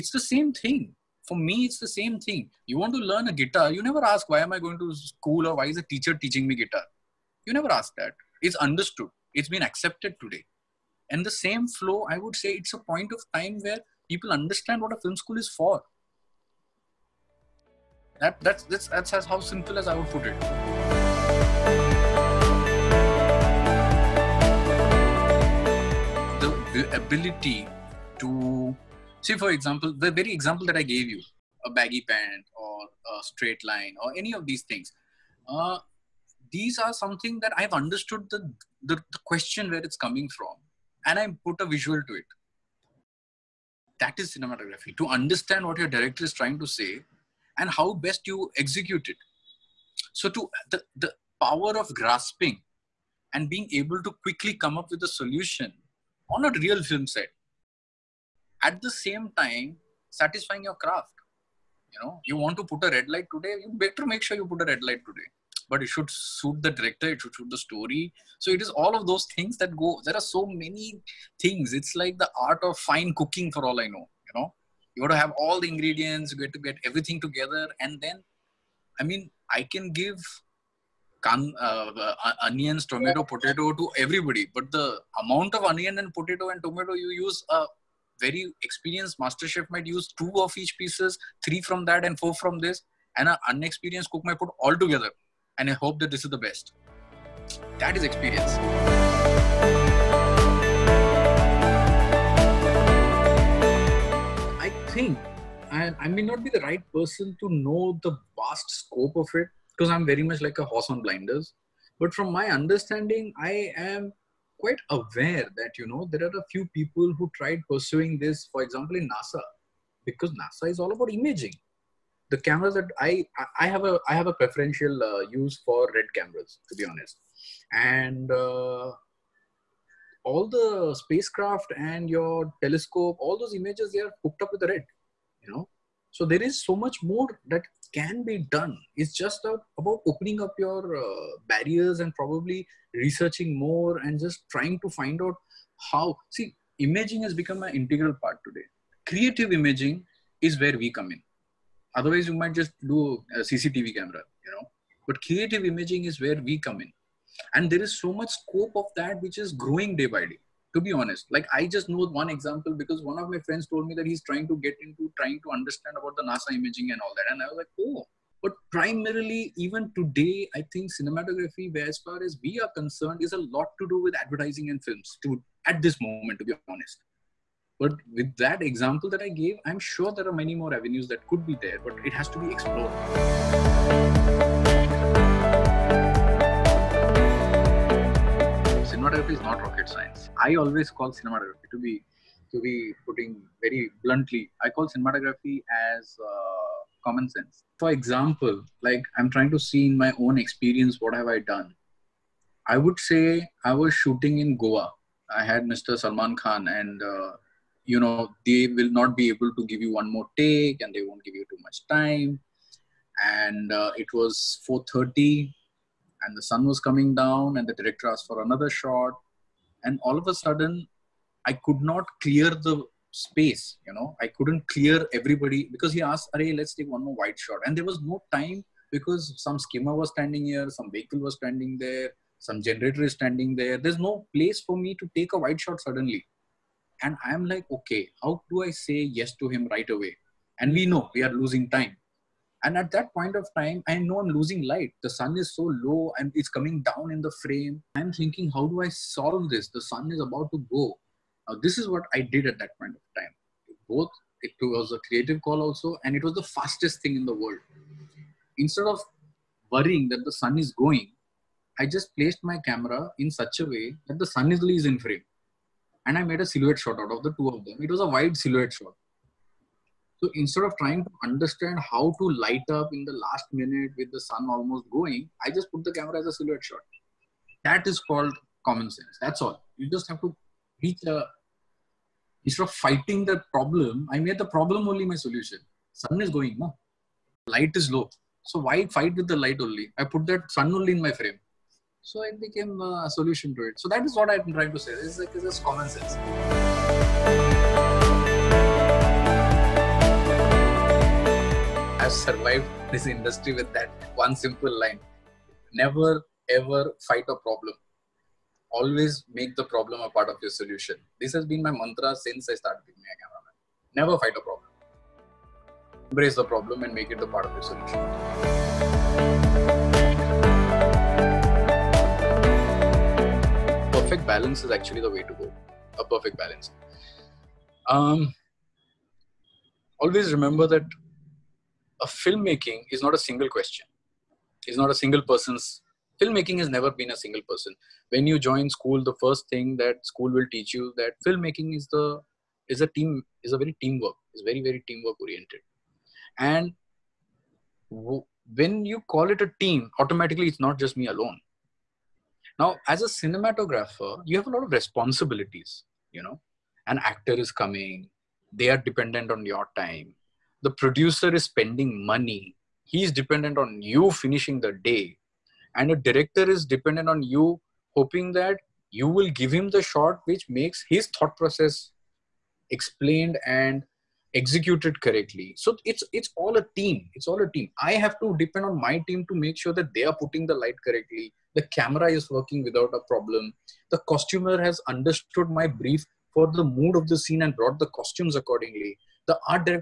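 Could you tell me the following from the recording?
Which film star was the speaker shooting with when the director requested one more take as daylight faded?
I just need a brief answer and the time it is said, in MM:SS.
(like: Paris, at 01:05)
Salman Khan, at 03:25.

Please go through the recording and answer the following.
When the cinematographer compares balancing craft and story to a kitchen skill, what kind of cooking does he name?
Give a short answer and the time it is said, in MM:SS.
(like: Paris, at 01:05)
fine cooking, at 01:12.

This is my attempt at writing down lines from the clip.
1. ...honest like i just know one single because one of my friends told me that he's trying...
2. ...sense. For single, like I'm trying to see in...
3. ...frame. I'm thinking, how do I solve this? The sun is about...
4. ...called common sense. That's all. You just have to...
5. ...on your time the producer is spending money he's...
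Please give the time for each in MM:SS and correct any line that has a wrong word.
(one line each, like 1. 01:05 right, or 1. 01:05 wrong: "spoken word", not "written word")
1. 02:40 wrong: "example", not "single"
2. 03:17 wrong: "example", not "single"
3. 04:07 right
4. 04:37 right
5. 05:59 right.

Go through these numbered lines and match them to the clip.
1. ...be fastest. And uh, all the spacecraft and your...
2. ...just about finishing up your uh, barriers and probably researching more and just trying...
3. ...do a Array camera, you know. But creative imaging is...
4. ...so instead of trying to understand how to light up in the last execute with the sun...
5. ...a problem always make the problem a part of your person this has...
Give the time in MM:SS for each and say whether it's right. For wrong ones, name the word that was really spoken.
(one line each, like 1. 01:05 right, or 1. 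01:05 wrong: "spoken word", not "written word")
1. 02:06 wrong: "honest", not "fastest"
2. 02:19 wrong: "opening", not "finishing"
3. 02:32 wrong: "CCTV", not "Array"
4. 04:30 wrong: "minute", not "execute"
5. 05:07 wrong: "solution", not "person".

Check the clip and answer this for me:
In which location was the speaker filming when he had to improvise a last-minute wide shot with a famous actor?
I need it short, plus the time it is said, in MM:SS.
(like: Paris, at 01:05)
Goa, at 03:24.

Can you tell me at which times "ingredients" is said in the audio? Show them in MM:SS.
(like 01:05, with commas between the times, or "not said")
01:15.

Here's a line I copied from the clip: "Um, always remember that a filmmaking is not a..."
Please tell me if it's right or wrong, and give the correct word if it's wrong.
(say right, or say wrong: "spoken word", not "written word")
right.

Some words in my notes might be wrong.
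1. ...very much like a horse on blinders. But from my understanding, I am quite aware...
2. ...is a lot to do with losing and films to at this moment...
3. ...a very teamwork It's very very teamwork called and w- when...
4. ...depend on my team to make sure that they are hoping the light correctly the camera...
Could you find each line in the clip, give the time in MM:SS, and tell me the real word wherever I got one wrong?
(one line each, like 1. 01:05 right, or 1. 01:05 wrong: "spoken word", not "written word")
1. 01:50 right
2. 02:53 wrong: "advertising", not "losing"
3. 05:43 wrong: "oriented", not "called"
4. 06:18 wrong: "putting", not "hoping".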